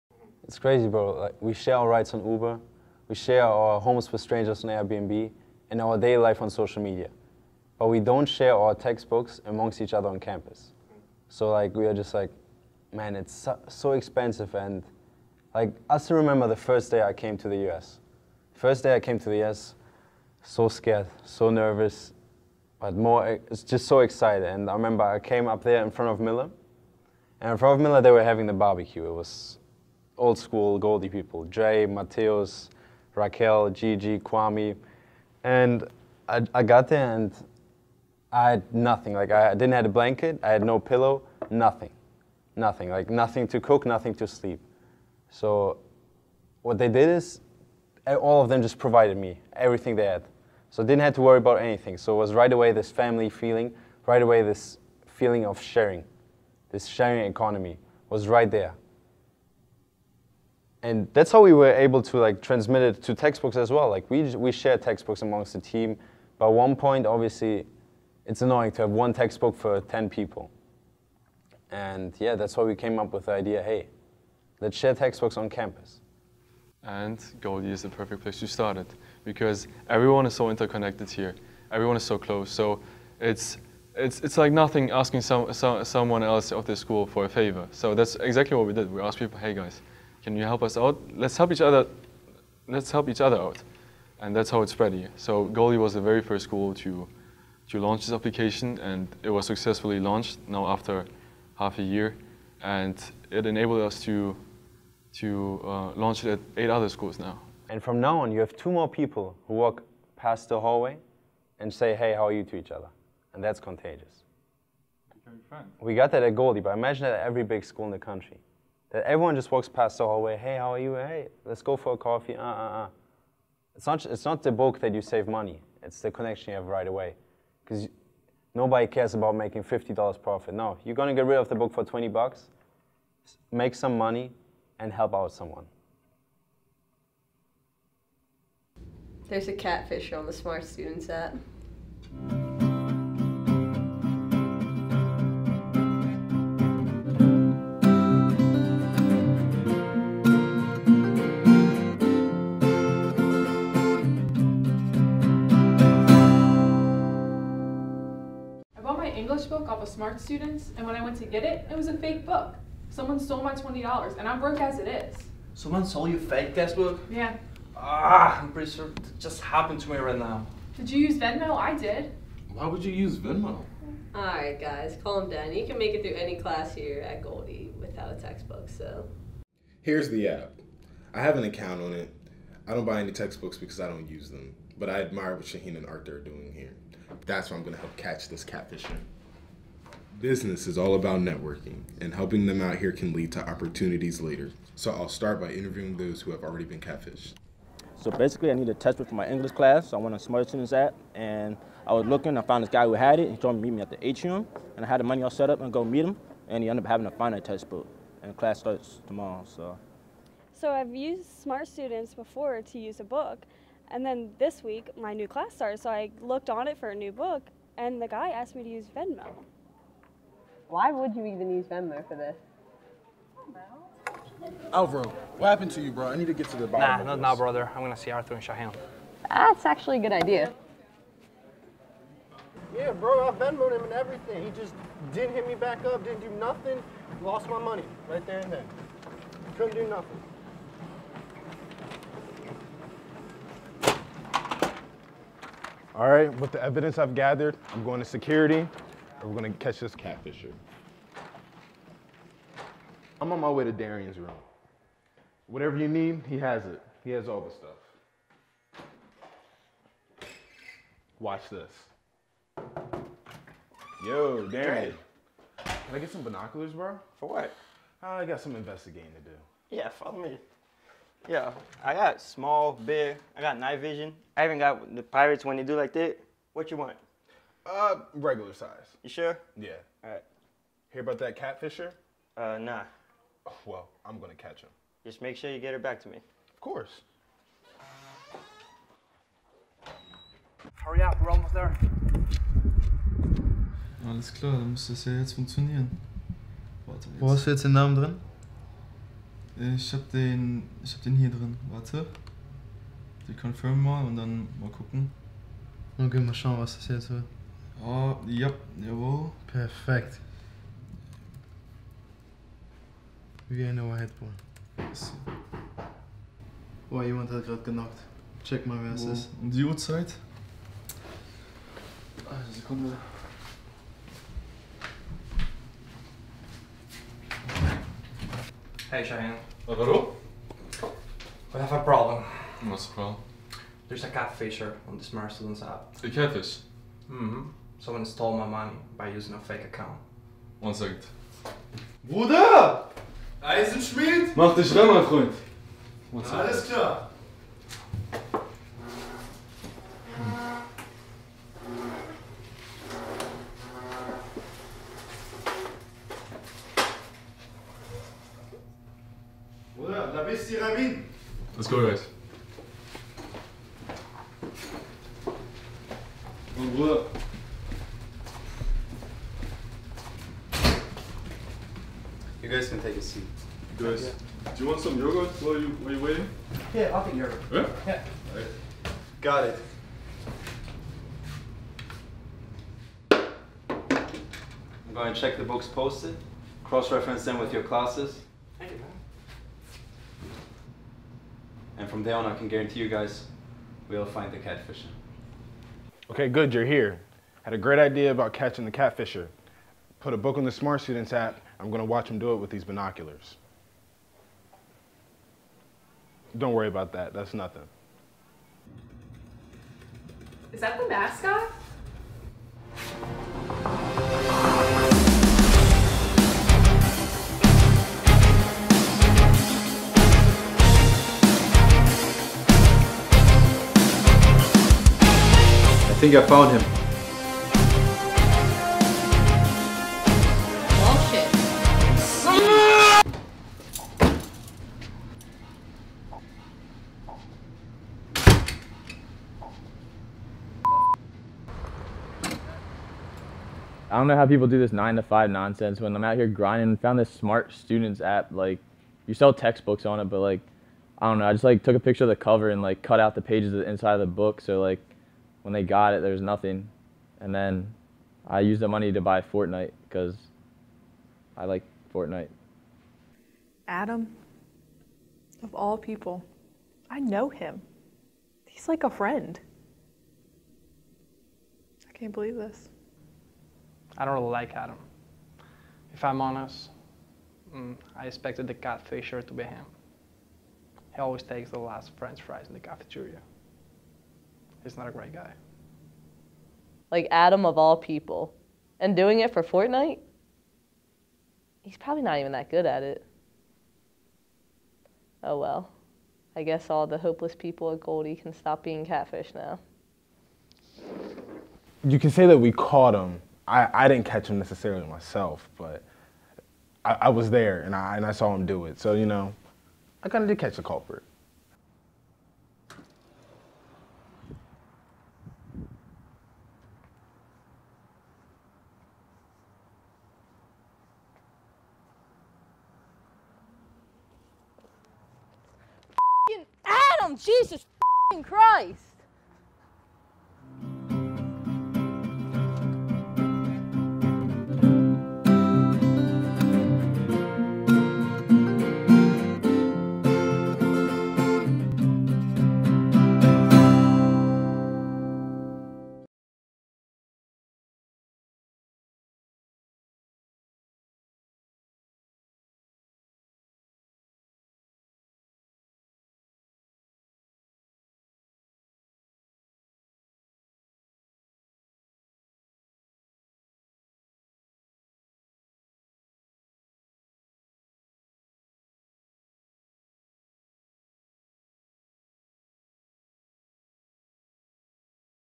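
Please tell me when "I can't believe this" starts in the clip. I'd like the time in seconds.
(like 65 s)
471 s.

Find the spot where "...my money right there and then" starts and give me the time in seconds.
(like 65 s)
237 s.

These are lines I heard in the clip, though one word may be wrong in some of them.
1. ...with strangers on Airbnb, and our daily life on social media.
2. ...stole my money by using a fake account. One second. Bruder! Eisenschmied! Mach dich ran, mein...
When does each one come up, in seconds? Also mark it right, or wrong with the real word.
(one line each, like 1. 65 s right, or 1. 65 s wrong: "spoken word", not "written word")
1. 4 s right
2. 338 s right.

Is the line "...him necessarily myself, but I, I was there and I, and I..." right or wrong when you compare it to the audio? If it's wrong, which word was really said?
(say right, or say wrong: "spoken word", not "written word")
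right.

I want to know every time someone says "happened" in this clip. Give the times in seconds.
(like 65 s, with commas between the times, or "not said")
169 s, 225 s.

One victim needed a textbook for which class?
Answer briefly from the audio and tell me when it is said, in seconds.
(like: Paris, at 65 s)
English, at 199 s.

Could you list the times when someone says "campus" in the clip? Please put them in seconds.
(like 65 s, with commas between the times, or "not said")
10 s, 75 s.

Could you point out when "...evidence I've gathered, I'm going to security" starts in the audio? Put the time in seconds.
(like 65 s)
246 s.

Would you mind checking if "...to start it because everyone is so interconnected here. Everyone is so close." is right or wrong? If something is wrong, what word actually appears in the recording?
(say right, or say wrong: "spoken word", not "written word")
right.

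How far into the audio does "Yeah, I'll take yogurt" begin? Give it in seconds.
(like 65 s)
376 s.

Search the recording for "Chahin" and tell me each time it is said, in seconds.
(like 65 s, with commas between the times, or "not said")
185 s, 228 s.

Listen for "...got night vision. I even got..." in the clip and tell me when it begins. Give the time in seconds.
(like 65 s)
273 s.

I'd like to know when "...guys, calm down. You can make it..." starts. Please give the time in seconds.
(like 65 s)
174 s.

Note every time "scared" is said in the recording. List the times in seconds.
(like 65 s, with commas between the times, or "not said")
20 s.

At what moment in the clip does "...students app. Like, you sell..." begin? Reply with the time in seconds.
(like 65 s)
447 s.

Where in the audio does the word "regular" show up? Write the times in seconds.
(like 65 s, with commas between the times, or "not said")
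278 s.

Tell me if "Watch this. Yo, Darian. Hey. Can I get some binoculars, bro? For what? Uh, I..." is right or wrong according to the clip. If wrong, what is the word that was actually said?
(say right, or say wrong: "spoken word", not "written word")
right.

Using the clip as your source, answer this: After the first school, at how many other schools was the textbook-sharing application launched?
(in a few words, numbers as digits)
8.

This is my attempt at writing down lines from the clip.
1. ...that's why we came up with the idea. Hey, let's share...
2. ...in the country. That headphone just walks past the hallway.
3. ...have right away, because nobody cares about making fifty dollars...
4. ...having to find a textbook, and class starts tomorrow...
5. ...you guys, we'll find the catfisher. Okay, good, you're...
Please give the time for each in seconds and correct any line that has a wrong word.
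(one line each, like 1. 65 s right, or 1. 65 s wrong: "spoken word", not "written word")
1. 72 s right
2. 117 s wrong: "everyone", not "headphone"
3. 126 s right
4. 206 s right
5. 392 s right.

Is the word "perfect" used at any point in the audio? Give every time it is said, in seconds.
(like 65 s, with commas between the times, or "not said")
77 s, 309 s.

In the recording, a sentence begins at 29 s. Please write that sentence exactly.
It was old school Goldey people, Jay, Mateos, Raquel, Gigi, Kwame.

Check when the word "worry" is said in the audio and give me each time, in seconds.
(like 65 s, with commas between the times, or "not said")
51 s, 406 s.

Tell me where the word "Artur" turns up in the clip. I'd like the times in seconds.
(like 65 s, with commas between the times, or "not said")
185 s, 228 s.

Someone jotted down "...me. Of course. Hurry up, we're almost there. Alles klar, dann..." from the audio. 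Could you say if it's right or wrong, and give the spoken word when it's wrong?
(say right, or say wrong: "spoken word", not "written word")
right.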